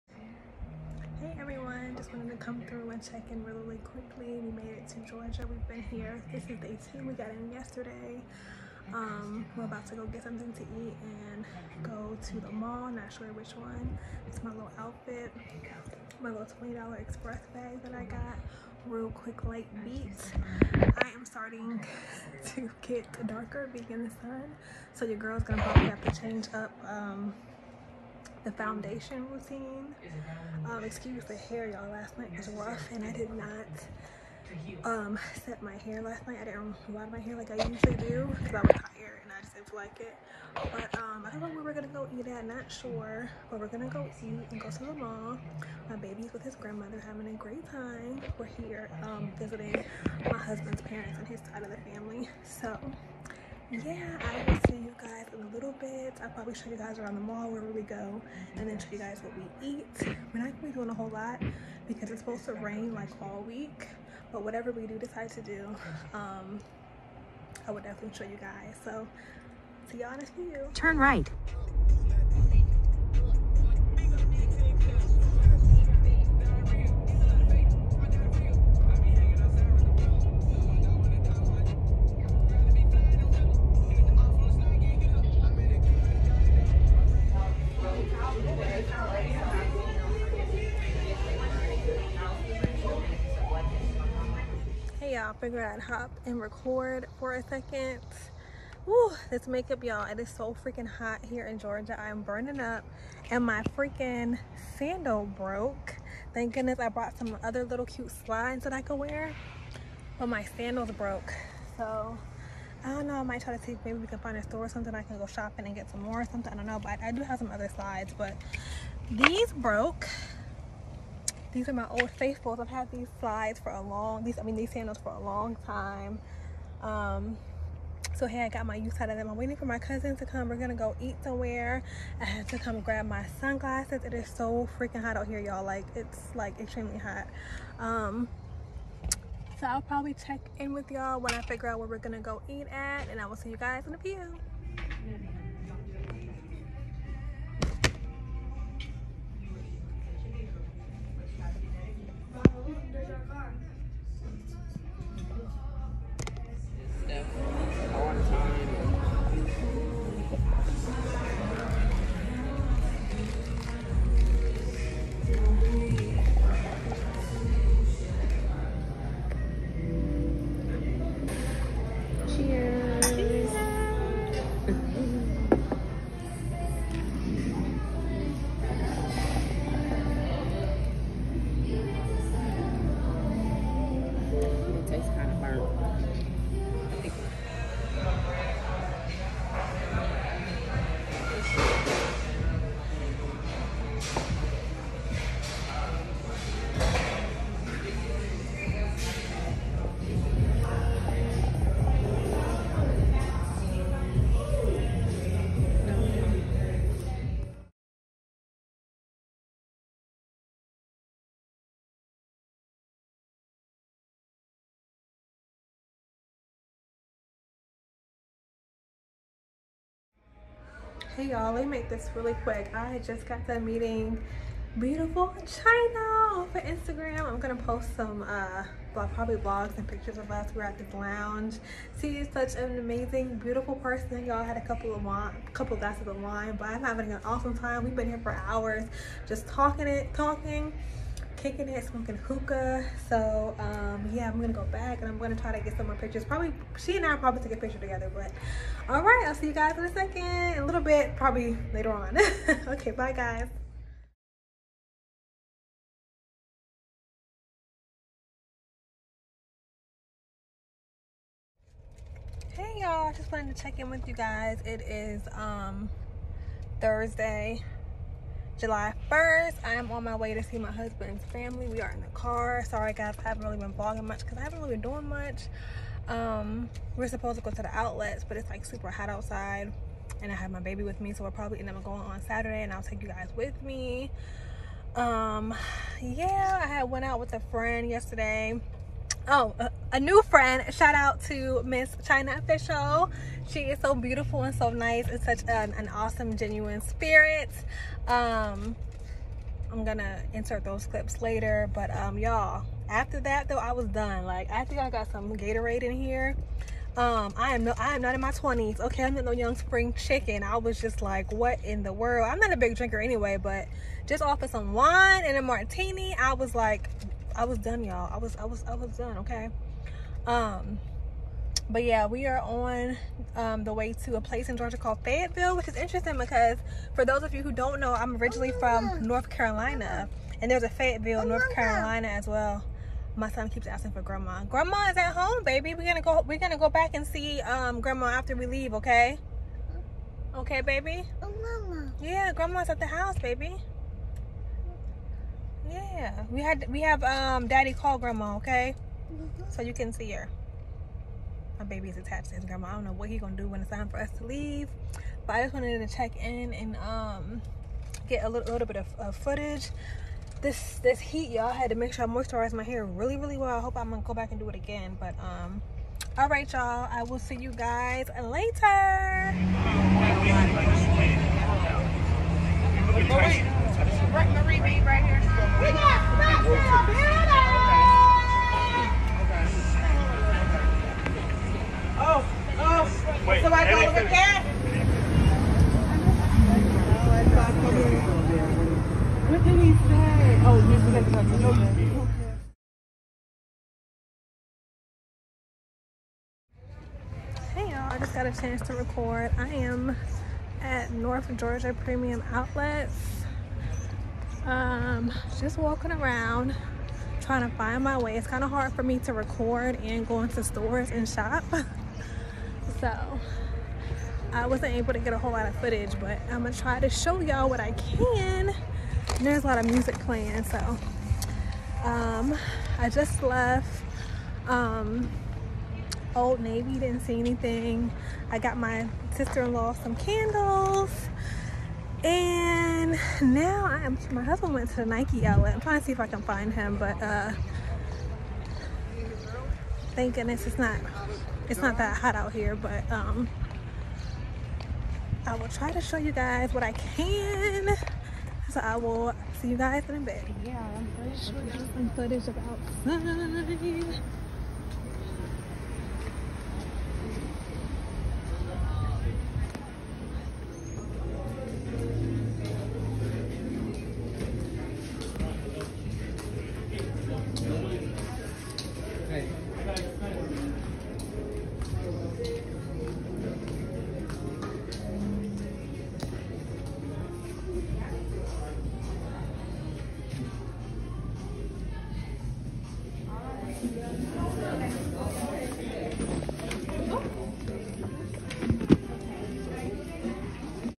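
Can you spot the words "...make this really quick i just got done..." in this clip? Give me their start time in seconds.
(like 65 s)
221 s.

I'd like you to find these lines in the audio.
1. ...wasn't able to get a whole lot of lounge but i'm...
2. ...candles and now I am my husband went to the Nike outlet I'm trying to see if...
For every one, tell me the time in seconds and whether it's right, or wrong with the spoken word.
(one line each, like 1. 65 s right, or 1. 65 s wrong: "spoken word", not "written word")
1. 414 s wrong: "footage", not "lounge"
2. 429 s right.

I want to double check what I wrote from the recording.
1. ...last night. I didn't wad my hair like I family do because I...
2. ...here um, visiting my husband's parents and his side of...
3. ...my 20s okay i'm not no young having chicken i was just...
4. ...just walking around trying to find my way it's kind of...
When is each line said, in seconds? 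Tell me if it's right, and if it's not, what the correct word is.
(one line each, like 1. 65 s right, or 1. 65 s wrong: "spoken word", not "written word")
1. 36 s wrong: "usually", not "family"
2. 48 s right
3. 308 s wrong: "spring", not "having"
4. 405 s right.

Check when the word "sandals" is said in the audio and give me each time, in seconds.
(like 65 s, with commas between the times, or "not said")
104 s, 110 s, 124 s.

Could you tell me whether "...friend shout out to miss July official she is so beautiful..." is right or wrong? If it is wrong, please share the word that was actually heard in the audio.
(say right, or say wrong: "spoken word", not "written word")
wrong: "Chyna", not "July".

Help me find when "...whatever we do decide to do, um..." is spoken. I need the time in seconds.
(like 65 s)
64 s.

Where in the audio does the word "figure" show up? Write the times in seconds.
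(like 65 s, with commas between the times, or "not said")
95 s, 141 s.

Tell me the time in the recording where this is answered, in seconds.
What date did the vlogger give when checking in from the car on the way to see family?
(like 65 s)
266 s.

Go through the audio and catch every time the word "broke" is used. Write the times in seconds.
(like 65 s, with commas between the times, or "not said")
105 s, 110 s, 119 s.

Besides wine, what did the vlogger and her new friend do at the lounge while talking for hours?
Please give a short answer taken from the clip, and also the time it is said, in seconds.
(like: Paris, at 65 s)
Smoking hookah, at 241 s.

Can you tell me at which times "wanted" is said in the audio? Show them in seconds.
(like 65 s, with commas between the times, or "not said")
263 s, 355 s.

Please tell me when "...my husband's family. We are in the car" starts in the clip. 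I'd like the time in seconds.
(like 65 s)
270 s.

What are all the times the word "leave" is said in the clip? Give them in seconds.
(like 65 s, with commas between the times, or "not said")
338 s, 354 s.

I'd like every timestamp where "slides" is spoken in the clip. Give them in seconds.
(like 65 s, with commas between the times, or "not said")
108 s, 117 s, 123 s.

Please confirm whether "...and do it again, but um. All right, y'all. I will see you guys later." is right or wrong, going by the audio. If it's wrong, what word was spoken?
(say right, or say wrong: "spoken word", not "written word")
right.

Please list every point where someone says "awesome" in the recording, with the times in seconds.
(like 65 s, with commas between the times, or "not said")
237 s, 295 s.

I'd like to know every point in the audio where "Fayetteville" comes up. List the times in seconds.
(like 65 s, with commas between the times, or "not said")
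325 s, 330 s.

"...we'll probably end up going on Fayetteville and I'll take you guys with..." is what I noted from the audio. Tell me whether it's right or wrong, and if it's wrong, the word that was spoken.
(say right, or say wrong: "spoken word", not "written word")
wrong: "Saturday", not "Fayetteville".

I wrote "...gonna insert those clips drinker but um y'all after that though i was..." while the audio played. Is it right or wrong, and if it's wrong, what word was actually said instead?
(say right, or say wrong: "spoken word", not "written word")
wrong: "later", not "drinker".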